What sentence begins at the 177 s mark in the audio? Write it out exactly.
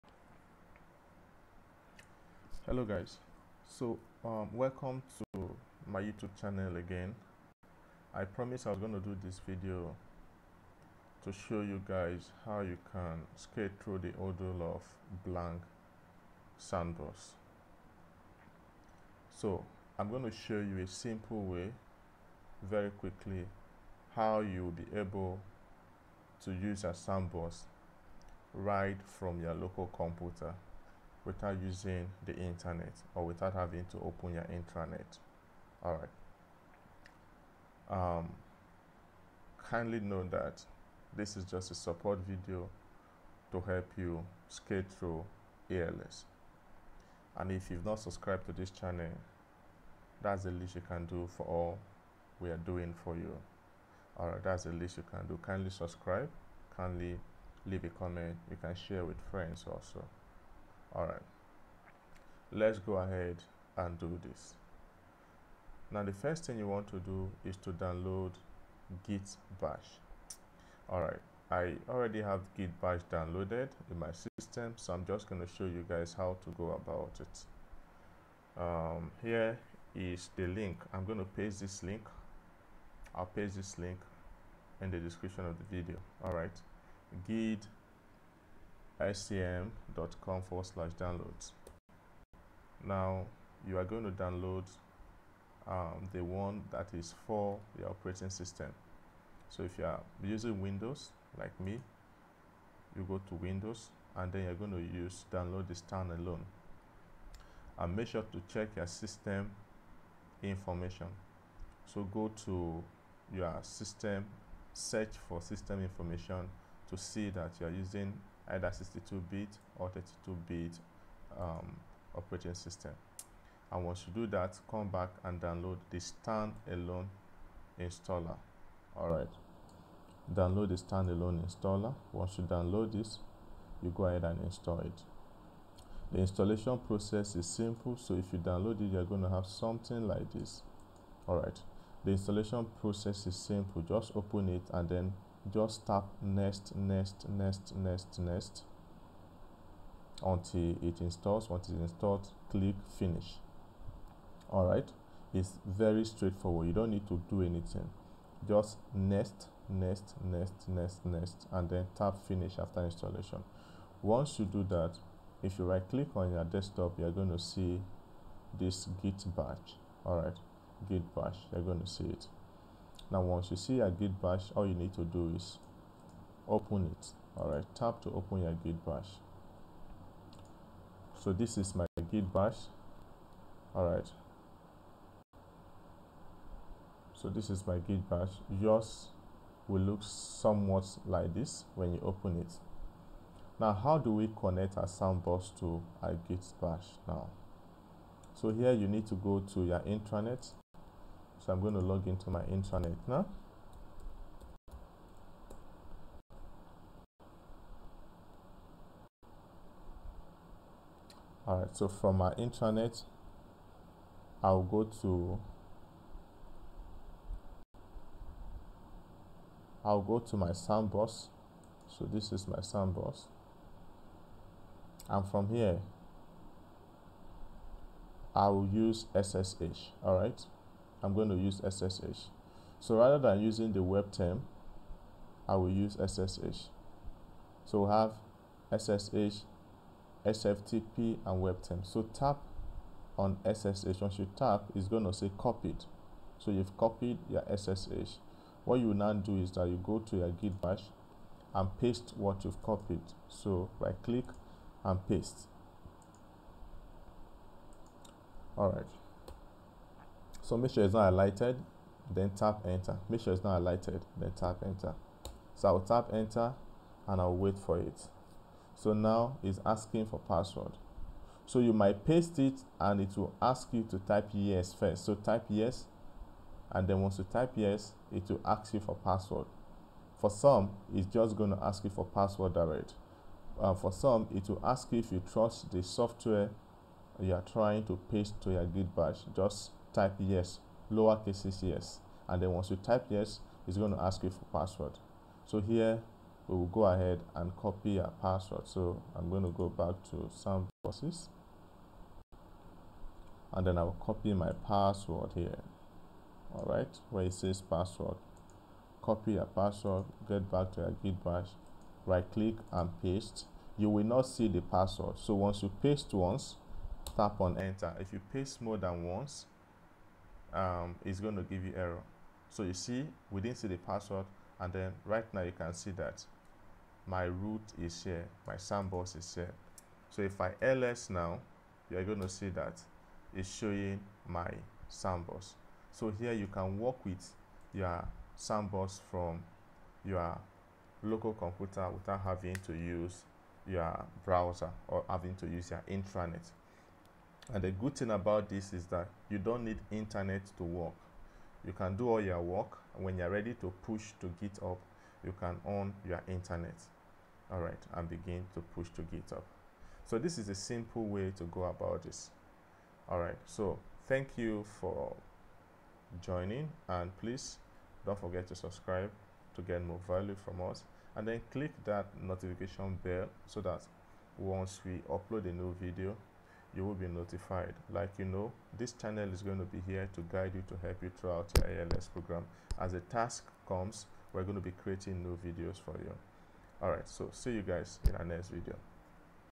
Alright, tap to open your git bash.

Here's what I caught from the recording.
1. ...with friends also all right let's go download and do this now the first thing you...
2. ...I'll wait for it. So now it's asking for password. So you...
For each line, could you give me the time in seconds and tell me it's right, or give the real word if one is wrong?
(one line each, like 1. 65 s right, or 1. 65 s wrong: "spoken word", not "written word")
1. 59 s wrong: "ahead", not "download"
2. 267 s right.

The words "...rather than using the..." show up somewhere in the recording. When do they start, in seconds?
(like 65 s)
232 s.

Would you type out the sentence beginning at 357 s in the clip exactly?
All right, and begin to push to GitHub.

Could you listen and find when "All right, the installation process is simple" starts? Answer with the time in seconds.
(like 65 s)
141 s.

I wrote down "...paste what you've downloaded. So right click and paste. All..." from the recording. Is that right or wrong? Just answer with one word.
wrong.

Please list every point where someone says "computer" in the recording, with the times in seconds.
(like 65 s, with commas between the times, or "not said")
29 s, 341 s.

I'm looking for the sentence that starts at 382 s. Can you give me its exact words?
As a task comes, we're going to be creating new videos for you.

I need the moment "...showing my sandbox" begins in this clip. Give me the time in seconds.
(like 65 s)
333 s.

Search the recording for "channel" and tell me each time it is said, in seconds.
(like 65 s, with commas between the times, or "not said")
6 s, 48 s, 378 s.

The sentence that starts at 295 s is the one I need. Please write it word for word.
So here we will go ahead and copy our password.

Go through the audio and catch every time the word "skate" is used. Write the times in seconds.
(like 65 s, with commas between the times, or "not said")
13 s, 44 s.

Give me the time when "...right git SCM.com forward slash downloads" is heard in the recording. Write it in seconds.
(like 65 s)
86 s.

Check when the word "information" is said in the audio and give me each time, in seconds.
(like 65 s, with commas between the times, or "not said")
110 s, 115 s.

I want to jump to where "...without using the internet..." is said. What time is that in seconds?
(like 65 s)
31 s.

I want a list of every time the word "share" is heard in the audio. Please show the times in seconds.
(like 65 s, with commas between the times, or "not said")
58 s.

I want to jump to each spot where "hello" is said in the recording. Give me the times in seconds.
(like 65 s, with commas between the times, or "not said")
2 s.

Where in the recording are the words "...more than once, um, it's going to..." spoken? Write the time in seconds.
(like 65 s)
318 s.